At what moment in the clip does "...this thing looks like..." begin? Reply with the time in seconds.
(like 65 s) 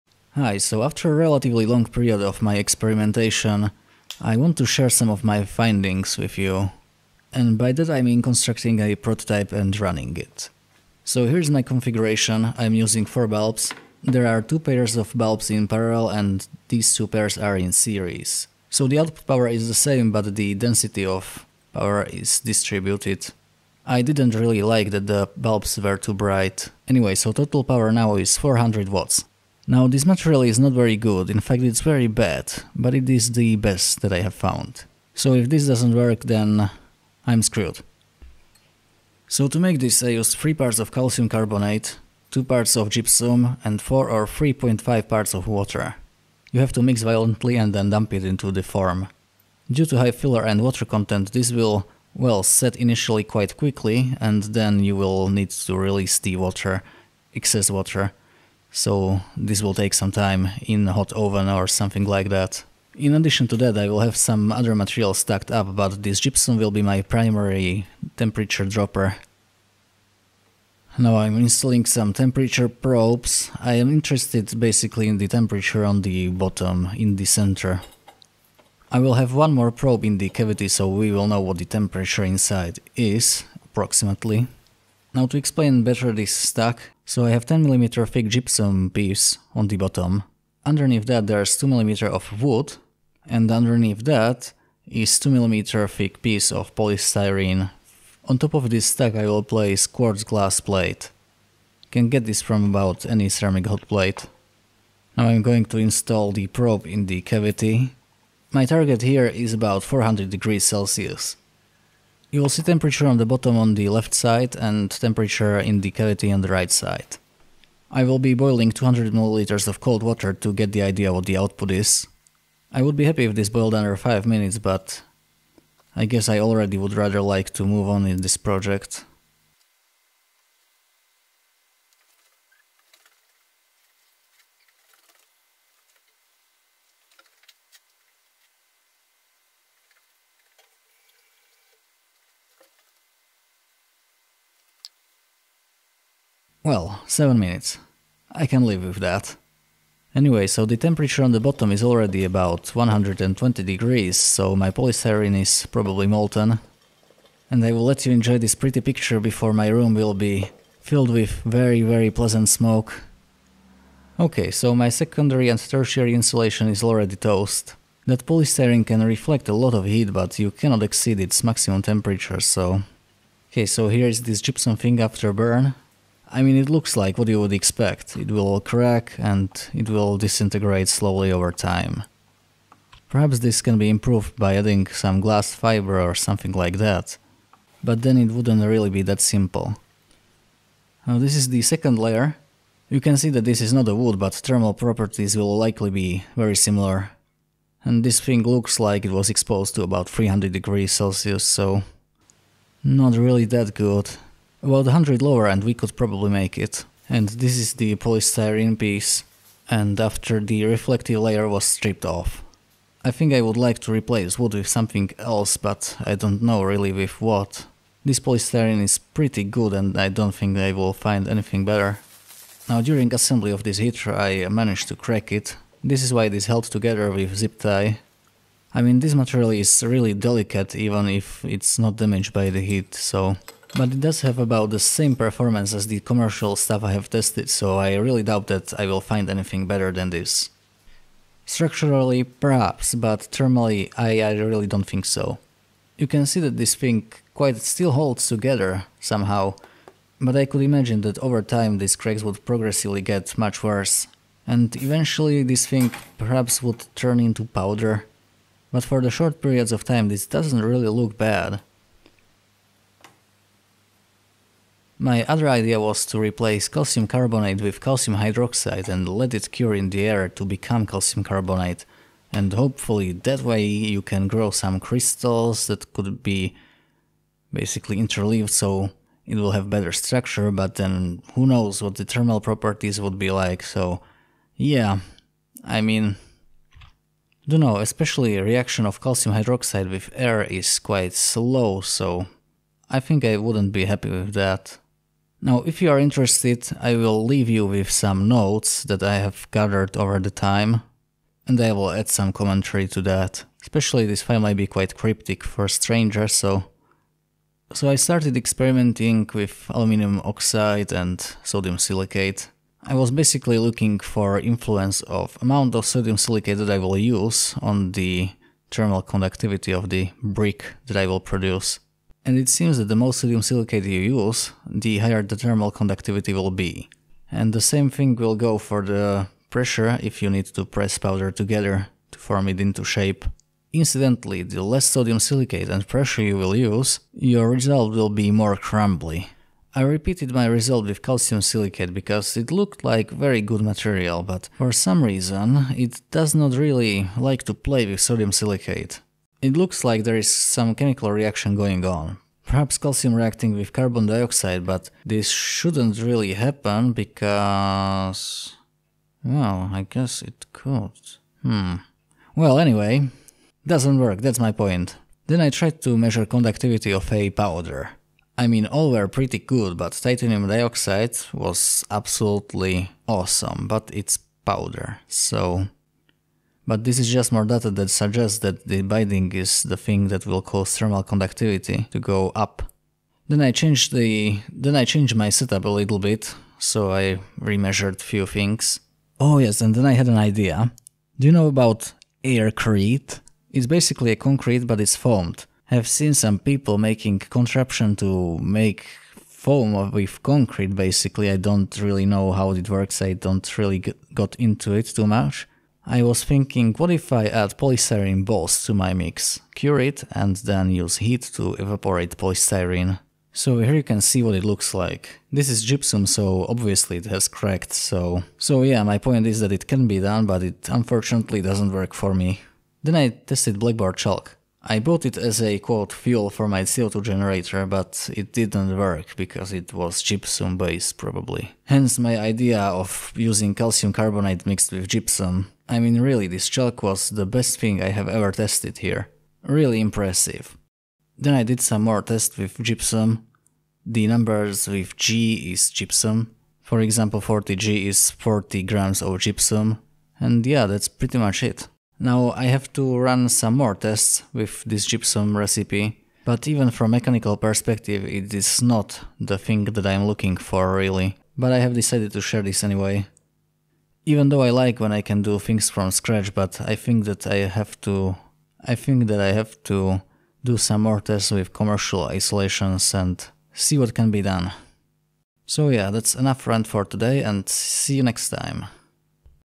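198 s.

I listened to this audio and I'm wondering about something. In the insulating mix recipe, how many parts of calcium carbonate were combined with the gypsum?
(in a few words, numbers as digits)
3.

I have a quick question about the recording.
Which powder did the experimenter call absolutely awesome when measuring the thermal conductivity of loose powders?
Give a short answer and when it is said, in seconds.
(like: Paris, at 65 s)
titanium dioxide, at 369 s.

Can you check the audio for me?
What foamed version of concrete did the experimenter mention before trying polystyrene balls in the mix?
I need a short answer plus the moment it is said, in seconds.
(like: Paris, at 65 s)
aircrete, at 392 s.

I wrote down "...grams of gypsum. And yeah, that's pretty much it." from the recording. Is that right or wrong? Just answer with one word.
right.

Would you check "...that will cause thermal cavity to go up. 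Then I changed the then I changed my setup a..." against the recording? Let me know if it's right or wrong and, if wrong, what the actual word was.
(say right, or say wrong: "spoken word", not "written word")
wrong: "conductivity", not "cavity".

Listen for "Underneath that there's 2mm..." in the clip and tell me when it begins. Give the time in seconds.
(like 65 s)
90 s.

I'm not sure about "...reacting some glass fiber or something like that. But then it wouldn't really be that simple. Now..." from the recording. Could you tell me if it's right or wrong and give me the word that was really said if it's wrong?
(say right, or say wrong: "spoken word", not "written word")
wrong: "adding", not "reacting".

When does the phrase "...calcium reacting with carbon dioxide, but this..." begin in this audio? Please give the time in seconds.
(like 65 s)
352 s.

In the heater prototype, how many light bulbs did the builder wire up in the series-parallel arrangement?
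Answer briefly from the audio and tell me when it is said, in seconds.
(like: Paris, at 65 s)
4, at 13 s.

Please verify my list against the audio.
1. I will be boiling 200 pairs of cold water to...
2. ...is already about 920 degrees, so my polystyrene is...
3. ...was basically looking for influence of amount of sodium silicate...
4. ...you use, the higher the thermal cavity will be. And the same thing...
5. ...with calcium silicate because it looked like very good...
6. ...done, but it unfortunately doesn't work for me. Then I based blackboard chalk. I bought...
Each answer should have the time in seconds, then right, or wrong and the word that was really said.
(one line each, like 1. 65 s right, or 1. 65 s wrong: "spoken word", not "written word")
1. 117 s wrong: "milliliters", not "pairs"
2. 151 s wrong: "120", not "920"
3. 312 s right
4. 323 s wrong: "conductivity", not "cavity"
5. 340 s right
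6. 419 s wrong: "tested", not "based".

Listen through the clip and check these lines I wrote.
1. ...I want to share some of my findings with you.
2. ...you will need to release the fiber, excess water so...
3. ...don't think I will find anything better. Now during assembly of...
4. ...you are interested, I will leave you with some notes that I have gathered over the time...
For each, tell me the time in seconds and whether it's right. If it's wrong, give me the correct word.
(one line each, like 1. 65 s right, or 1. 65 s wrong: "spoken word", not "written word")
1. 4 s right
2. 54 s wrong: "water", not "fiber"
3. 220 s right
4. 295 s right.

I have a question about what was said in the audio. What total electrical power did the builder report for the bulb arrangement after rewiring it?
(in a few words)
400 watts.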